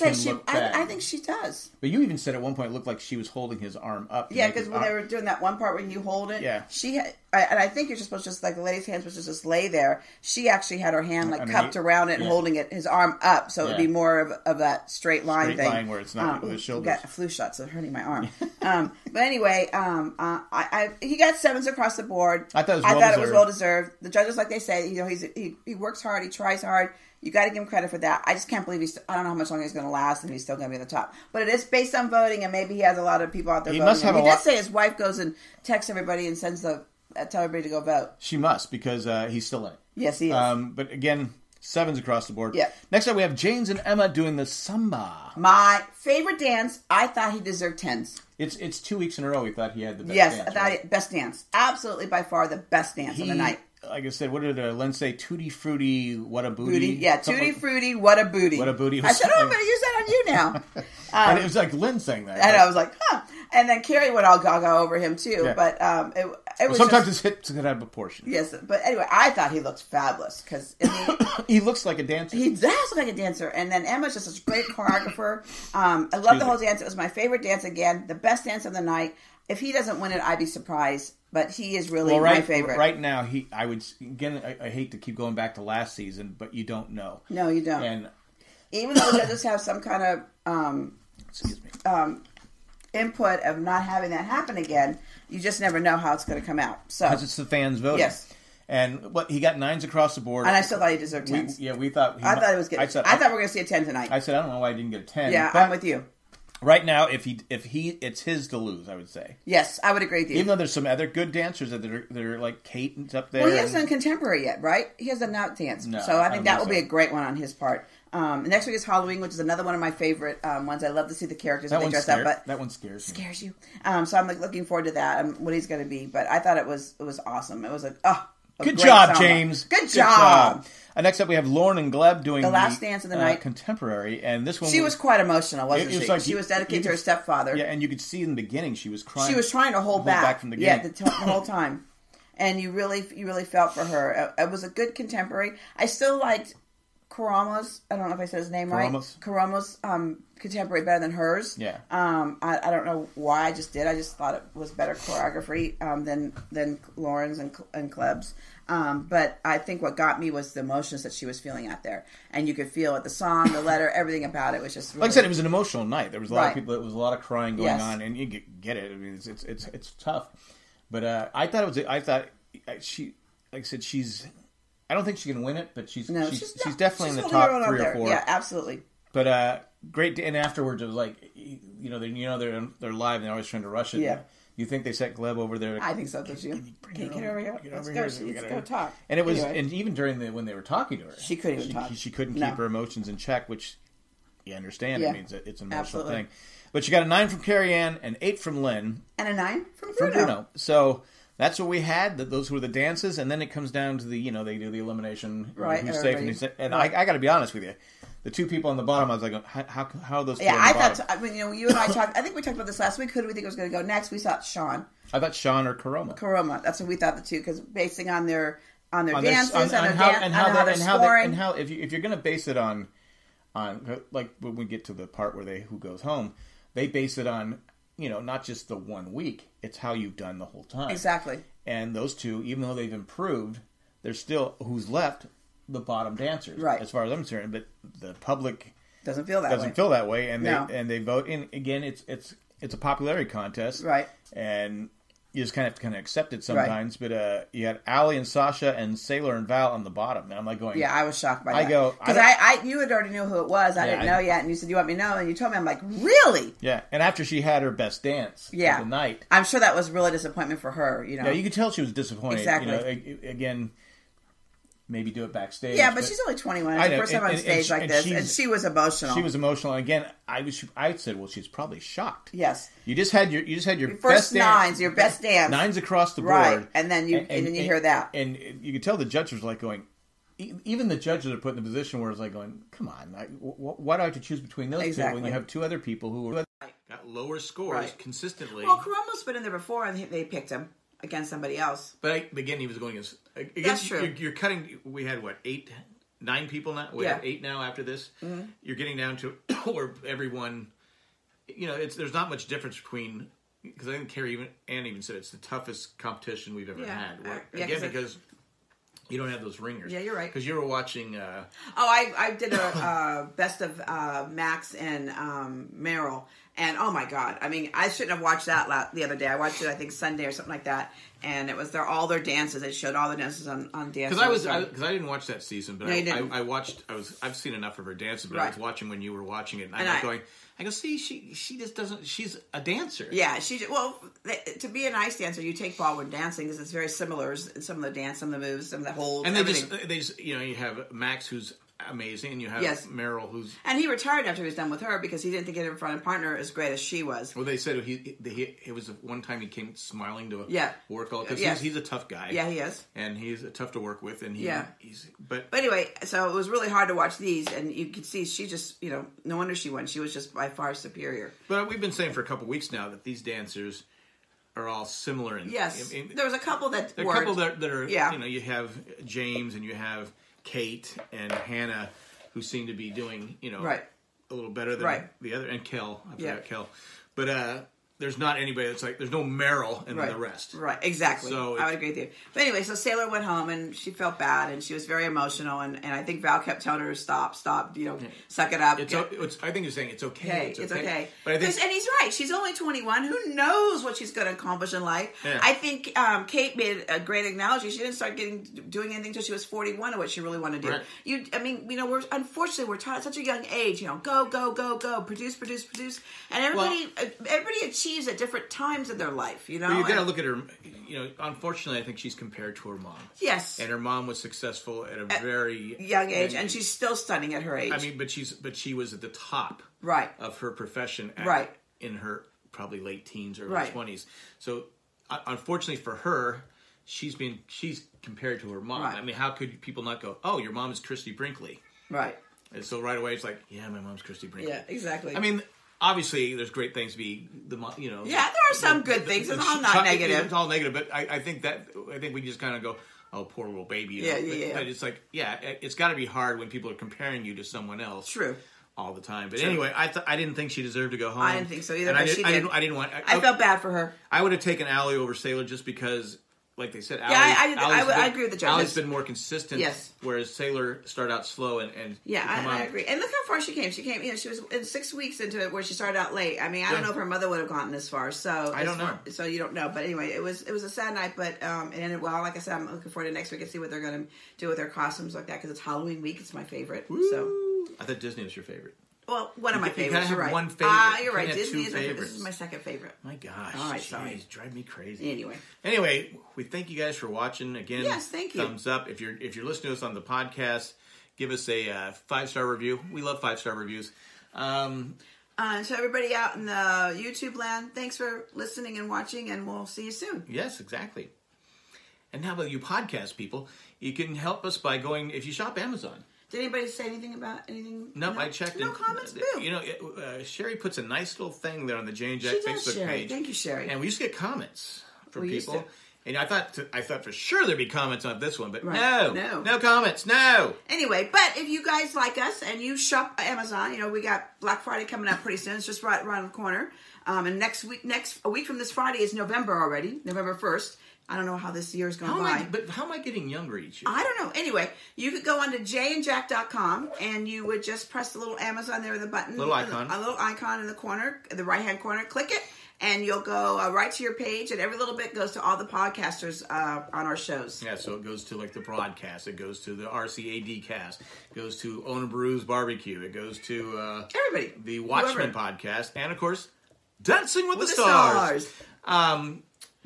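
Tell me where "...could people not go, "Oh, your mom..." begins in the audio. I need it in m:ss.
7:09.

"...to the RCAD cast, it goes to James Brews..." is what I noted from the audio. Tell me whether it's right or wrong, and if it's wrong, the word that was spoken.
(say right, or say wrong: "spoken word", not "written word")
wrong: "Owner", not "James".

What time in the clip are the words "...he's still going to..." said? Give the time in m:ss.
0:30.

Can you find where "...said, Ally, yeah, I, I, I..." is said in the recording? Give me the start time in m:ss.
7:36.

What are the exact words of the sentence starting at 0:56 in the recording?
booty yeah, tutti frutti, what a booty.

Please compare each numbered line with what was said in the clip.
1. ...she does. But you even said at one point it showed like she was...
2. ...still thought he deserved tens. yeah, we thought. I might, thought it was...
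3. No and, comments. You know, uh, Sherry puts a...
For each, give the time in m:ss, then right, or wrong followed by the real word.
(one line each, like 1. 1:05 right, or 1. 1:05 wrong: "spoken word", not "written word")
1. 0:01 wrong: "looked", not "showed"
2. 1:40 right
3. 8:28 right.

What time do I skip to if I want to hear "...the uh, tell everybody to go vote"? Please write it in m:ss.
0:36.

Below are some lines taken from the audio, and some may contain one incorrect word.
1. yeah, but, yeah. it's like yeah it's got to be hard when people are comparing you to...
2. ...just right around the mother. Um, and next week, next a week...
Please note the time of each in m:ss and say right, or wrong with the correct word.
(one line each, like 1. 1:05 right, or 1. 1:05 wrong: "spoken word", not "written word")
1. 7:24 right
2. 8:45 wrong: "corner", not "mother".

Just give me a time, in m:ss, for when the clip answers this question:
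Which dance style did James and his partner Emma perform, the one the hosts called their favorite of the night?
0:44.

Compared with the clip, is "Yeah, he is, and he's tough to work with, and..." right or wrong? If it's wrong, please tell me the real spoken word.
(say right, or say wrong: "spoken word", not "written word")
right.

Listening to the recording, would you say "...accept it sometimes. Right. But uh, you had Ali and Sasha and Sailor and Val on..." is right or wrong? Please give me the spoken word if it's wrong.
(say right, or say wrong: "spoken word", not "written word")
right.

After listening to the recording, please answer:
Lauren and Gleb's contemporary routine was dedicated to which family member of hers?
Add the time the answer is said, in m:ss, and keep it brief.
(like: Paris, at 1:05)
her stepfather, at 2:16.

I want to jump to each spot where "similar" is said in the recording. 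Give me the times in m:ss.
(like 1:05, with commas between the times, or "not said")
5:36, 6:04.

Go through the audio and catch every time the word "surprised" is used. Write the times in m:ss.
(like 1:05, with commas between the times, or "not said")
1:20.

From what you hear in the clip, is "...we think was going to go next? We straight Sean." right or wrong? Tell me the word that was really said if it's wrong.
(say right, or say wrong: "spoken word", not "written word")
wrong: "thought", not "straight".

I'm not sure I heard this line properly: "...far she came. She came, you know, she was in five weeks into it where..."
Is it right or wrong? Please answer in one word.
wrong.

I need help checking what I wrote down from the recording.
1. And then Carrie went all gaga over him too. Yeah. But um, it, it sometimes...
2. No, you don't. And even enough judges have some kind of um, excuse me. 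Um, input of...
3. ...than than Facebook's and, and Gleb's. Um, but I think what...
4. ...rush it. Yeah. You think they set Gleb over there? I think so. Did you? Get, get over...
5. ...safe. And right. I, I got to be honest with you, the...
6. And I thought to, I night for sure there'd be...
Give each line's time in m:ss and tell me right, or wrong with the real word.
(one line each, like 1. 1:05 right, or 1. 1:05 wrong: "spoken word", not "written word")
1. 1:03 right
2. 1:27 wrong: "though", not "enough"
3. 2:36 wrong: "Lauren", not "Facebook"
4. 3:03 right
5. 3:26 right
6. 8:36 wrong: "thought", not "night".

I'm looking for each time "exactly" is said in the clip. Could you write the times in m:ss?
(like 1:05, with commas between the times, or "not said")
3:50, 4:22, 4:44, 6:20, 7:14, 8:20.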